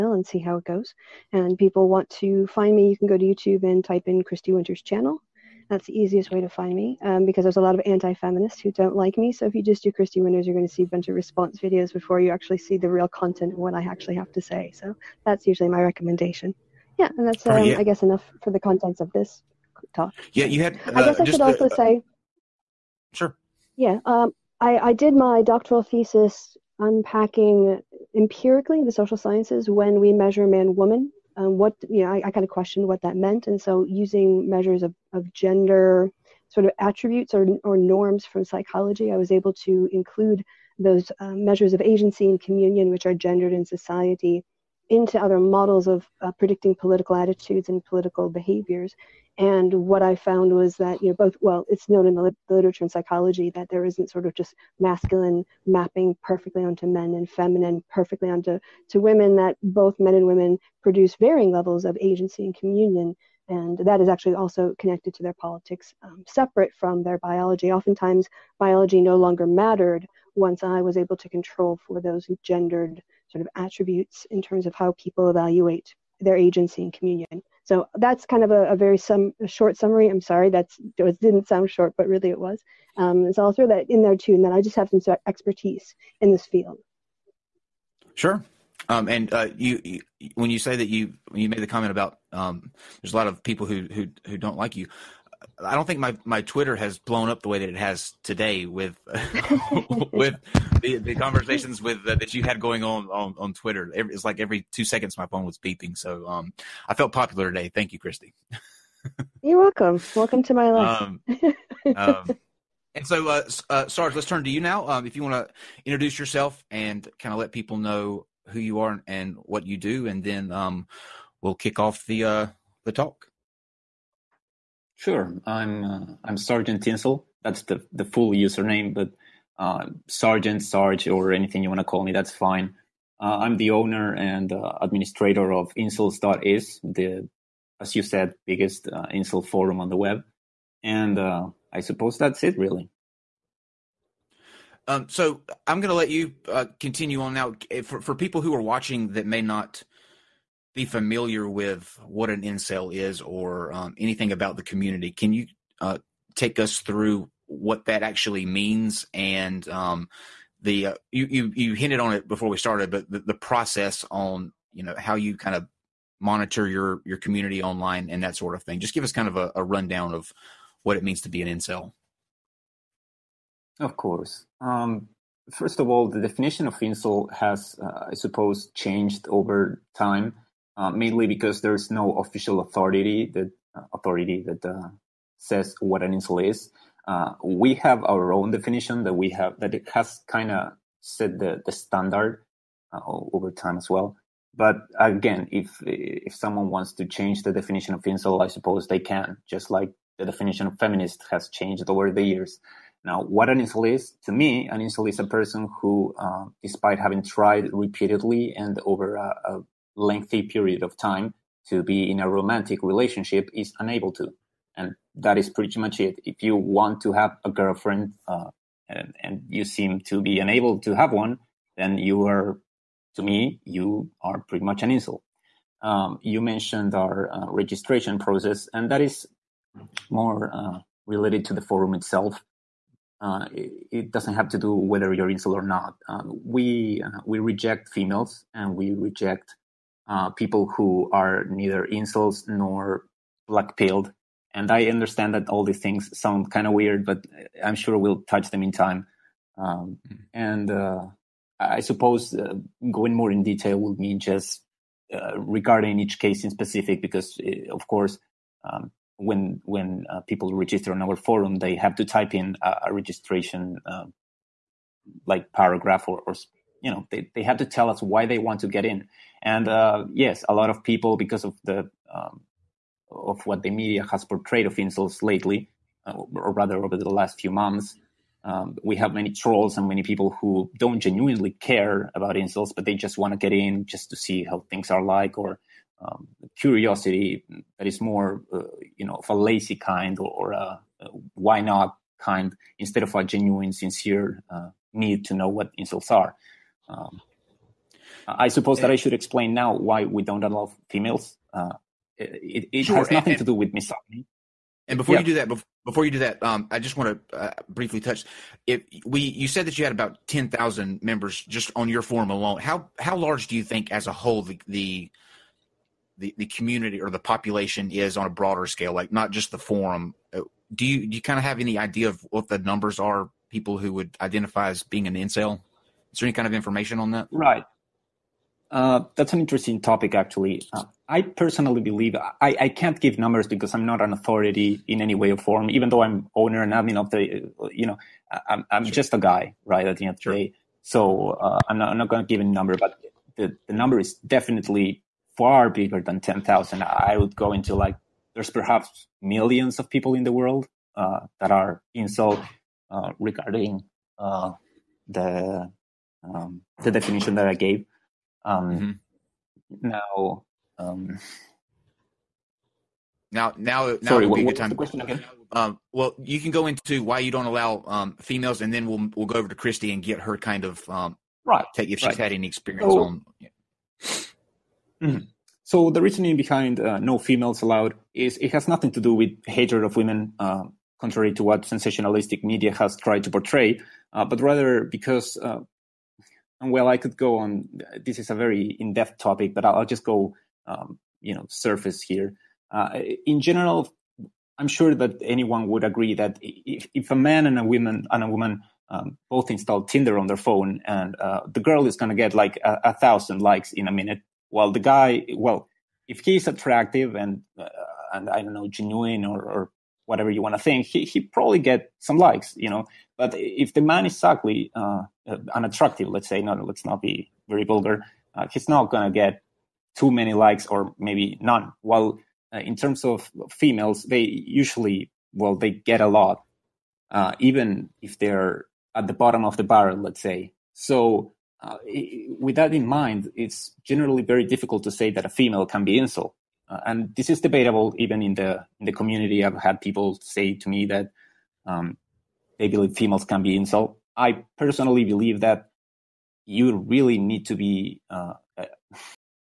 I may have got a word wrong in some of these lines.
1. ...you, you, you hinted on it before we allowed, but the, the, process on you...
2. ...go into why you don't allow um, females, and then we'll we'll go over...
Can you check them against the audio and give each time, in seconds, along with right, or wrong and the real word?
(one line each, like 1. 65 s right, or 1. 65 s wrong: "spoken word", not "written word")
1. 161 s wrong: "started", not "allowed"
2. 366 s right.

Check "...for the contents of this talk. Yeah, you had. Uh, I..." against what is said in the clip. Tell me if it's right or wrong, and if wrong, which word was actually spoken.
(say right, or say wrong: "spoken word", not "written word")
right.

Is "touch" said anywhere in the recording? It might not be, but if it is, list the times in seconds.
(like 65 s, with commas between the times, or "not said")
248 s, 308 s.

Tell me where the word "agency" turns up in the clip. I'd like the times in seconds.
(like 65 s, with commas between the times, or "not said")
41 s, 62 s, 76 s.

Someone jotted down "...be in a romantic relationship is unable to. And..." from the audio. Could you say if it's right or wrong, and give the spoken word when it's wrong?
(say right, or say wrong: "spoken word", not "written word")
right.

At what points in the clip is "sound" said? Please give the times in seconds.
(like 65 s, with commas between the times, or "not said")
81 s, 246 s.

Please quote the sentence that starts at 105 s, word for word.
So um, I felt popular today.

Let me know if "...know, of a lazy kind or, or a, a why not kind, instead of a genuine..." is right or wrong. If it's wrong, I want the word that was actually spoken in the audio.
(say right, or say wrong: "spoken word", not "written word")
right.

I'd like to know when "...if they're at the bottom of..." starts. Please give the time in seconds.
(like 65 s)
428 s.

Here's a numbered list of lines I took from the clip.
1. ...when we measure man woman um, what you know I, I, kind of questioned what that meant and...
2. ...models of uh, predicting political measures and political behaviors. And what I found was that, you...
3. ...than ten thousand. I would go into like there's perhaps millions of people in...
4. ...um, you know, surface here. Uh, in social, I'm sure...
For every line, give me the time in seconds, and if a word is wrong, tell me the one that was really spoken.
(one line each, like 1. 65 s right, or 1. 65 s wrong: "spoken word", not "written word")
1. 29 s right
2. 45 s wrong: "attitudes", not "measures"
3. 346 s right
4. 390 s wrong: "general", not "social".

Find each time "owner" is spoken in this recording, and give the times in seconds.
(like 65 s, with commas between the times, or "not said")
133 s, 336 s.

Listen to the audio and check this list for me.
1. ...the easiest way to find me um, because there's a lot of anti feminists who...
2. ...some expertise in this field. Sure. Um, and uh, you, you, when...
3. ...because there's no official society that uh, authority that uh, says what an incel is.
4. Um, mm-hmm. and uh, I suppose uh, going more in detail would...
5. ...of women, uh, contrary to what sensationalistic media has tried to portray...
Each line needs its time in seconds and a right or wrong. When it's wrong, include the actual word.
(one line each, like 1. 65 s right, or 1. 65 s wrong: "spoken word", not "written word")
1. 5 s right
2. 84 s right
3. 181 s wrong: "authority", not "society"
4. 249 s right
5. 379 s right.